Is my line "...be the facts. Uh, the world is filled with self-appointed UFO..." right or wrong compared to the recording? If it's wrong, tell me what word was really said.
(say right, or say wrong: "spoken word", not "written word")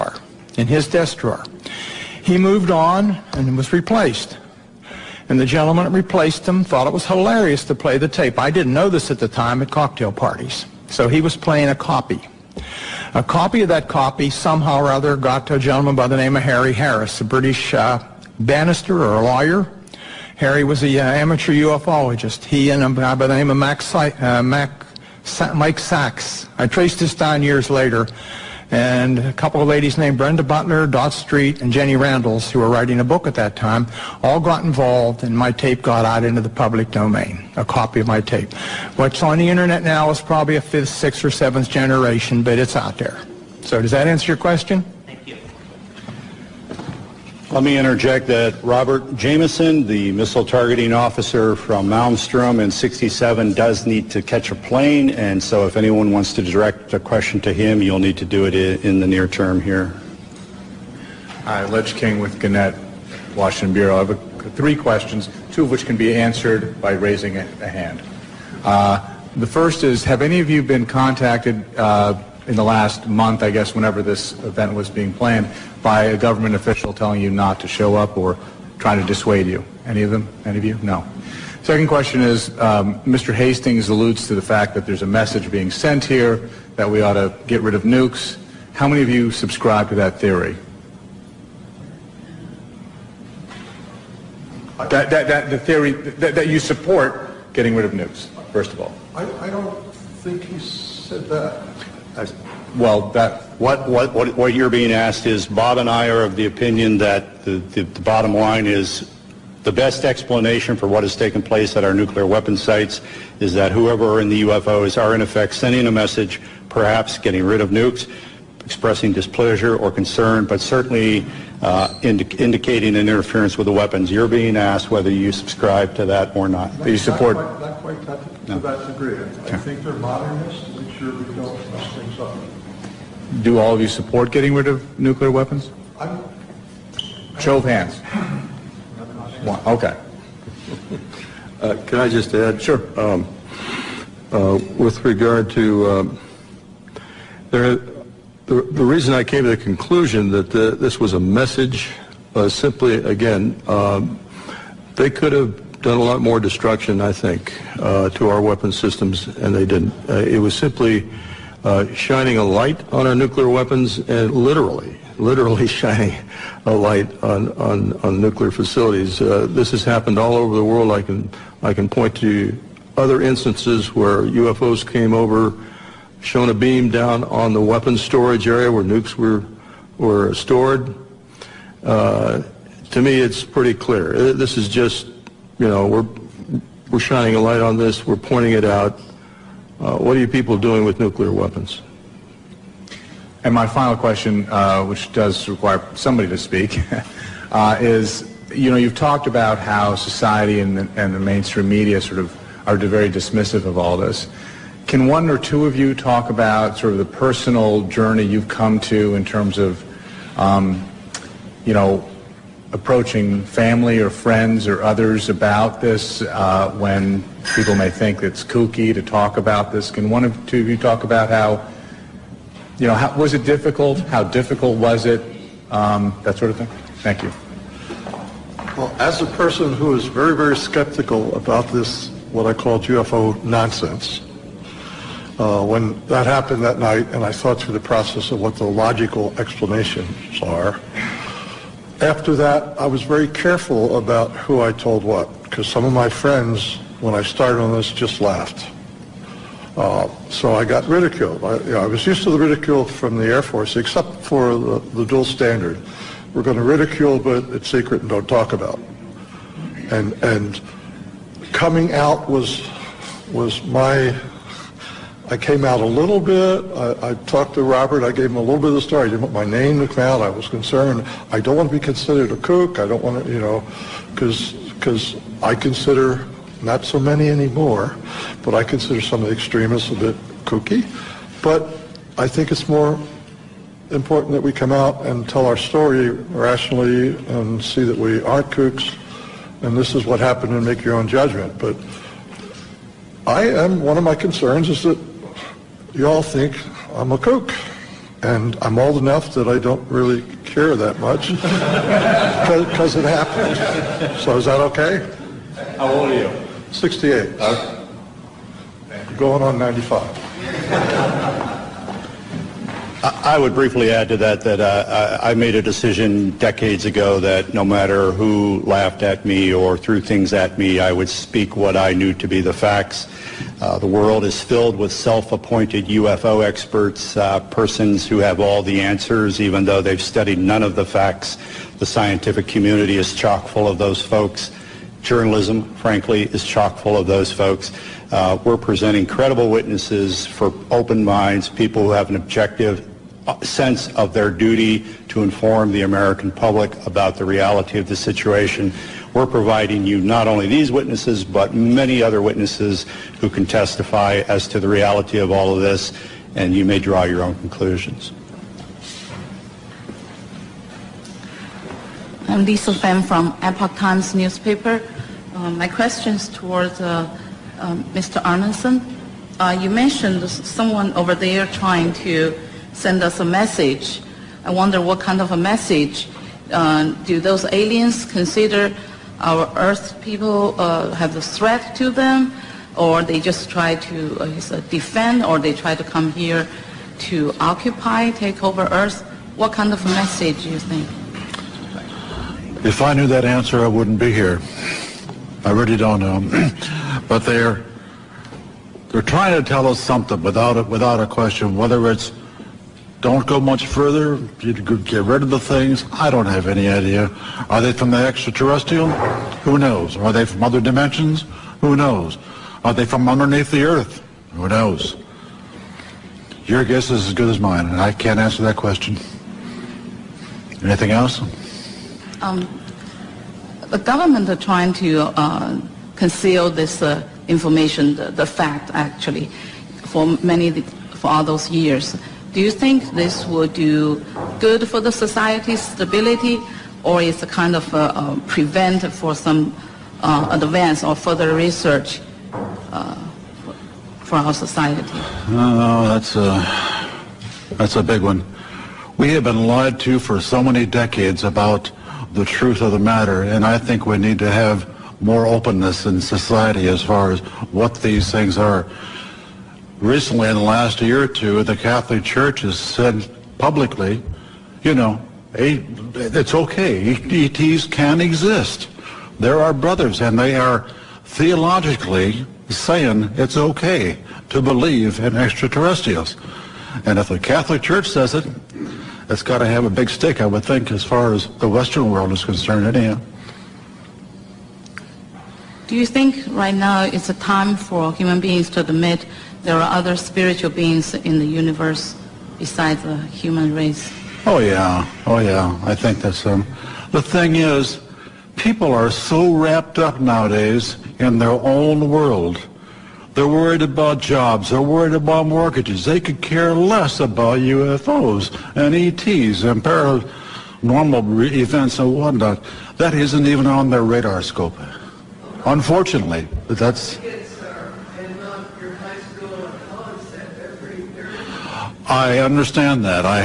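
right.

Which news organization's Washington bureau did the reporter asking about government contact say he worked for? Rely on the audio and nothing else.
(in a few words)
Gannett.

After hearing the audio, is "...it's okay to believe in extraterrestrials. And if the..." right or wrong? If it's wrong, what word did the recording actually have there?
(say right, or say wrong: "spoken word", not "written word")
right.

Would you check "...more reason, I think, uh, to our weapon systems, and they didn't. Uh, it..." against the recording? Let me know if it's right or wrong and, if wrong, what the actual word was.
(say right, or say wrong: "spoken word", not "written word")
wrong: "destruction", not "reason".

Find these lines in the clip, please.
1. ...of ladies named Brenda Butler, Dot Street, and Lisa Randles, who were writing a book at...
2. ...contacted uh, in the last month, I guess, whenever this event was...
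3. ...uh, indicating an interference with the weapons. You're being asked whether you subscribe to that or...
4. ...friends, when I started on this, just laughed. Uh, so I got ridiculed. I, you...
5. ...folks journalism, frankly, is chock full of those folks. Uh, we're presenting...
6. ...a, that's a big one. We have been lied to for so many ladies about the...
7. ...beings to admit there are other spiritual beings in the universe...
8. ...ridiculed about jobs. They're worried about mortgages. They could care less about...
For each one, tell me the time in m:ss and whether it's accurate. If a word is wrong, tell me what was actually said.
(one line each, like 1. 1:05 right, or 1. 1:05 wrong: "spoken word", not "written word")
1. 0:29 wrong: "Jenny", not "Lisa"
2. 1:10 right
3. 2:01 right
4. 4:06 right
5. 5:34 right
6. 7:26 wrong: "decades", not "ladies"
7. 8:08 right
8. 8:23 wrong: "worried", not "ridiculed".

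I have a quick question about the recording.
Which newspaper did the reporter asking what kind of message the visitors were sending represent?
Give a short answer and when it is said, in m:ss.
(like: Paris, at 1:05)
Epoch Times, at 6:03.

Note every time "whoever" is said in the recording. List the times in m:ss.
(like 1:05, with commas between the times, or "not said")
1:53.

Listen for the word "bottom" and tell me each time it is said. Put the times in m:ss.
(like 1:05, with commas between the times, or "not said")
1:48.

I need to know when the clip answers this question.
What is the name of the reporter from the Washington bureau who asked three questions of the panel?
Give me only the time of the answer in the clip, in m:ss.
1:01.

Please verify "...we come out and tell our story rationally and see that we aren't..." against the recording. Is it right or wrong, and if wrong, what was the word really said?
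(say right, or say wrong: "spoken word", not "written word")
right.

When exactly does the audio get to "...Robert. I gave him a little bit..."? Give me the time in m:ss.
4:27.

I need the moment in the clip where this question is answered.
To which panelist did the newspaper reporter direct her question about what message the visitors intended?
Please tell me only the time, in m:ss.
6:08.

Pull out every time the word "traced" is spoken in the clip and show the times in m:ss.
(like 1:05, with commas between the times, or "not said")
0:26.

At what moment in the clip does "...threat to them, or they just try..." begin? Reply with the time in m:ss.
6:21.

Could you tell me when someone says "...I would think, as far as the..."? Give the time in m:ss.
8:00.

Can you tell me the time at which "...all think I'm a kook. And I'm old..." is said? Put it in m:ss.
4:56.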